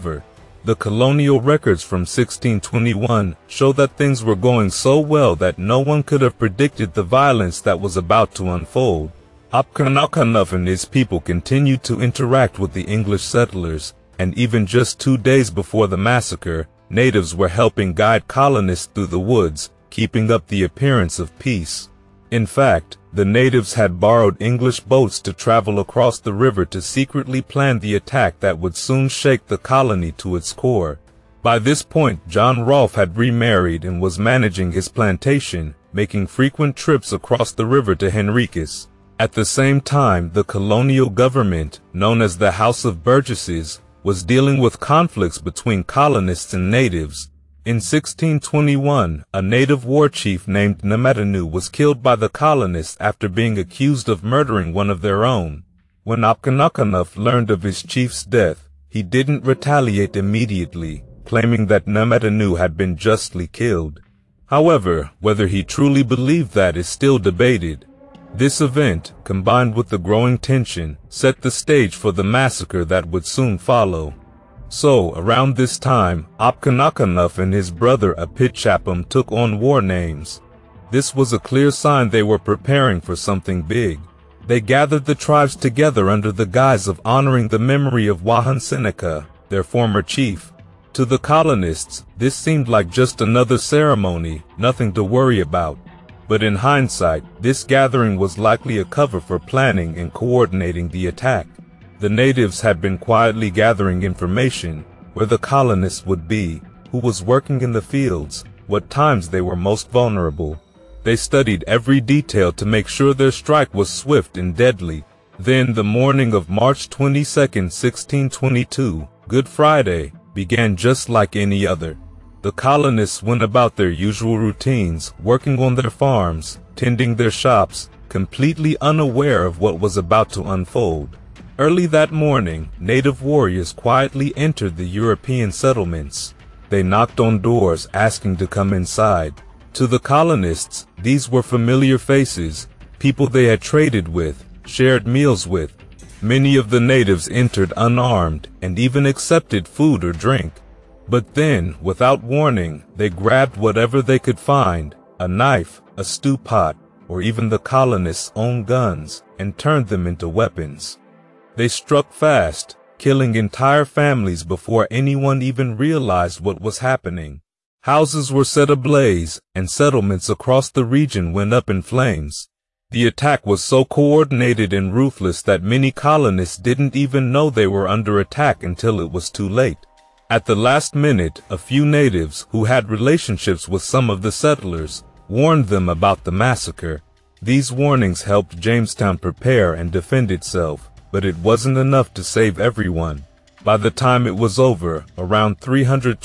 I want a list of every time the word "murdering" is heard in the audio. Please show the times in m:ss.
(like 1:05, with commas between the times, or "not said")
0:54.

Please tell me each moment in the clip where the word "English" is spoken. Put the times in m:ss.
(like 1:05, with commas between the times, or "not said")
0:12, 0:24.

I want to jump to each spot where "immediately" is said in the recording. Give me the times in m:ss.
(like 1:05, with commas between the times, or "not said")
1:00.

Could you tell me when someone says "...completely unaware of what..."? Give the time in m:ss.
2:08.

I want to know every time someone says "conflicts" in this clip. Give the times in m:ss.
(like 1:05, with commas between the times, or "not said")
0:44.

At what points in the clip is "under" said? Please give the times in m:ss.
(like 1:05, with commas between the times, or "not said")
1:26, 2:57.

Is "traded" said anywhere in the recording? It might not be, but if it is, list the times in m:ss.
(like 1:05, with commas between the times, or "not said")
2:23.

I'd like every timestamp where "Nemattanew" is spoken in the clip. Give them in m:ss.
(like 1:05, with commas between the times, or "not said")
0:50, 1:01.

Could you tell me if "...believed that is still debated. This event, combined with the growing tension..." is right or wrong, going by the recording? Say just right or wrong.
right.